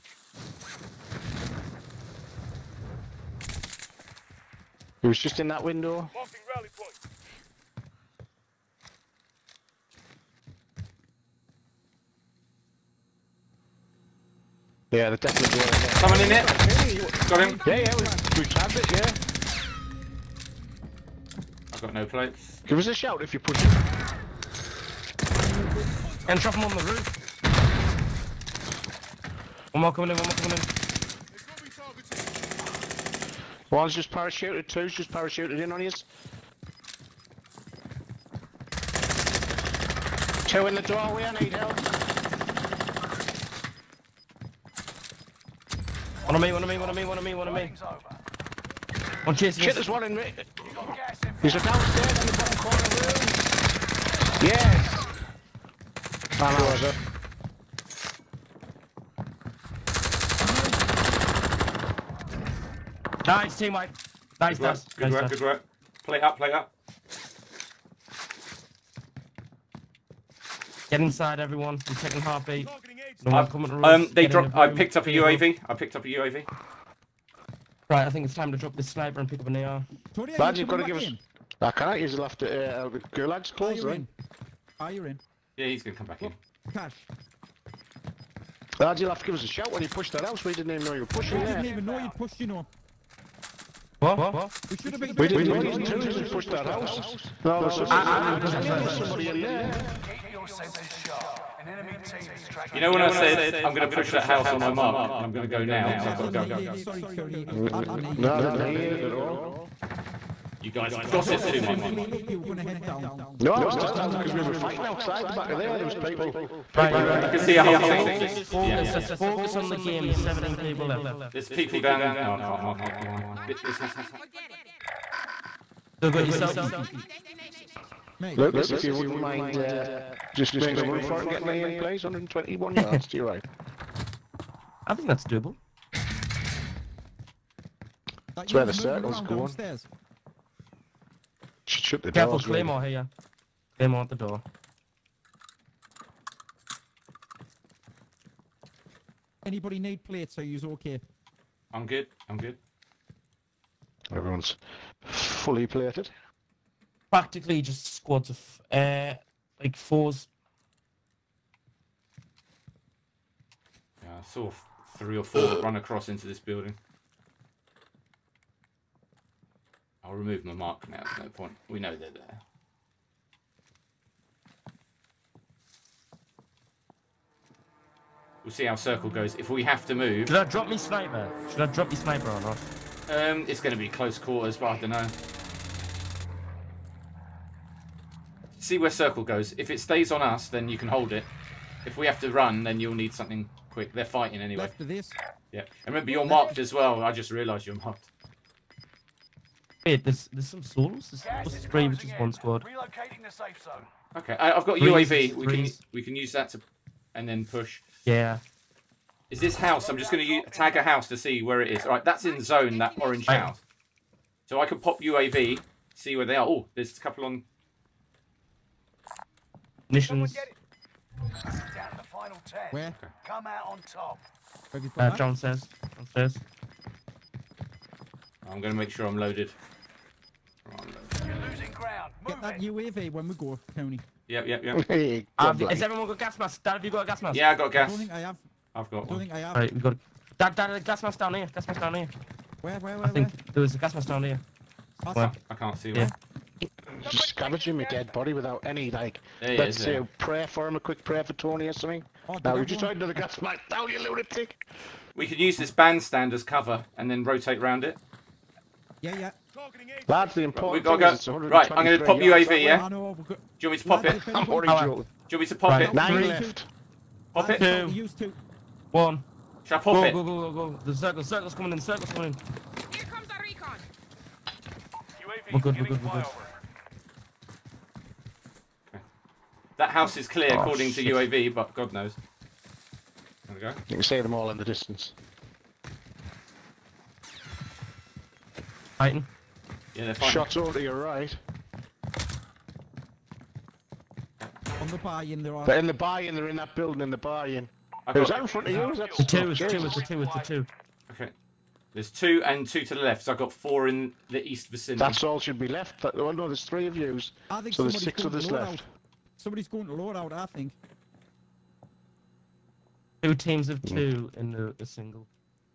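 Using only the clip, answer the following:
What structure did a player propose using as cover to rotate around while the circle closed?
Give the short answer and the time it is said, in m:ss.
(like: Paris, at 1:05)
bandstand, at 4:15.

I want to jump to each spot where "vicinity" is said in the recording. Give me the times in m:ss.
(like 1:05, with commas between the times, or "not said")
5:04.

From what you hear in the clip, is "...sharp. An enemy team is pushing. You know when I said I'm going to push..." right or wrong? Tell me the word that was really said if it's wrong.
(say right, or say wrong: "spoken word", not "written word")
wrong: "tracking", not "pushing".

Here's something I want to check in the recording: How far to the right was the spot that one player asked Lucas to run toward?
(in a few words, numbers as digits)
121 yards.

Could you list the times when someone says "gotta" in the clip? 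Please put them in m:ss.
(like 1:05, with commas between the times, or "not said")
4:21.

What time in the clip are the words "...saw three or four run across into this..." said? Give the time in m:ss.
2:44.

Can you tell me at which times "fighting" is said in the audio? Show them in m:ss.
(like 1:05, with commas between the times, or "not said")
1:54, 3:14.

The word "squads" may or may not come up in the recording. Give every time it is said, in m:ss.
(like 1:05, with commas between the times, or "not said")
2:37, 3:22.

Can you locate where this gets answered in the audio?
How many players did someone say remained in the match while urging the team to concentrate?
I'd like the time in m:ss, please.
2:00.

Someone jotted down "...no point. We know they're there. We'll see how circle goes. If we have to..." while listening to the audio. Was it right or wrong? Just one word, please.
right.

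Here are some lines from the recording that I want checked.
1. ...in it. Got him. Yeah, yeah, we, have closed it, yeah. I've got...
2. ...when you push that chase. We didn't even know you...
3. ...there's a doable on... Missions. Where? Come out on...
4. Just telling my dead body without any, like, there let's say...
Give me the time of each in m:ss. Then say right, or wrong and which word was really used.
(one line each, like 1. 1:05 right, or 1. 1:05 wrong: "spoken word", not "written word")
1. 0:16 wrong: "grabbed", not "closed"
2. 1:29 wrong: "house", not "chase"
3. 3:36 wrong: "couple", not "doable"
4. 4:07 wrong: "scavenging", not "telling".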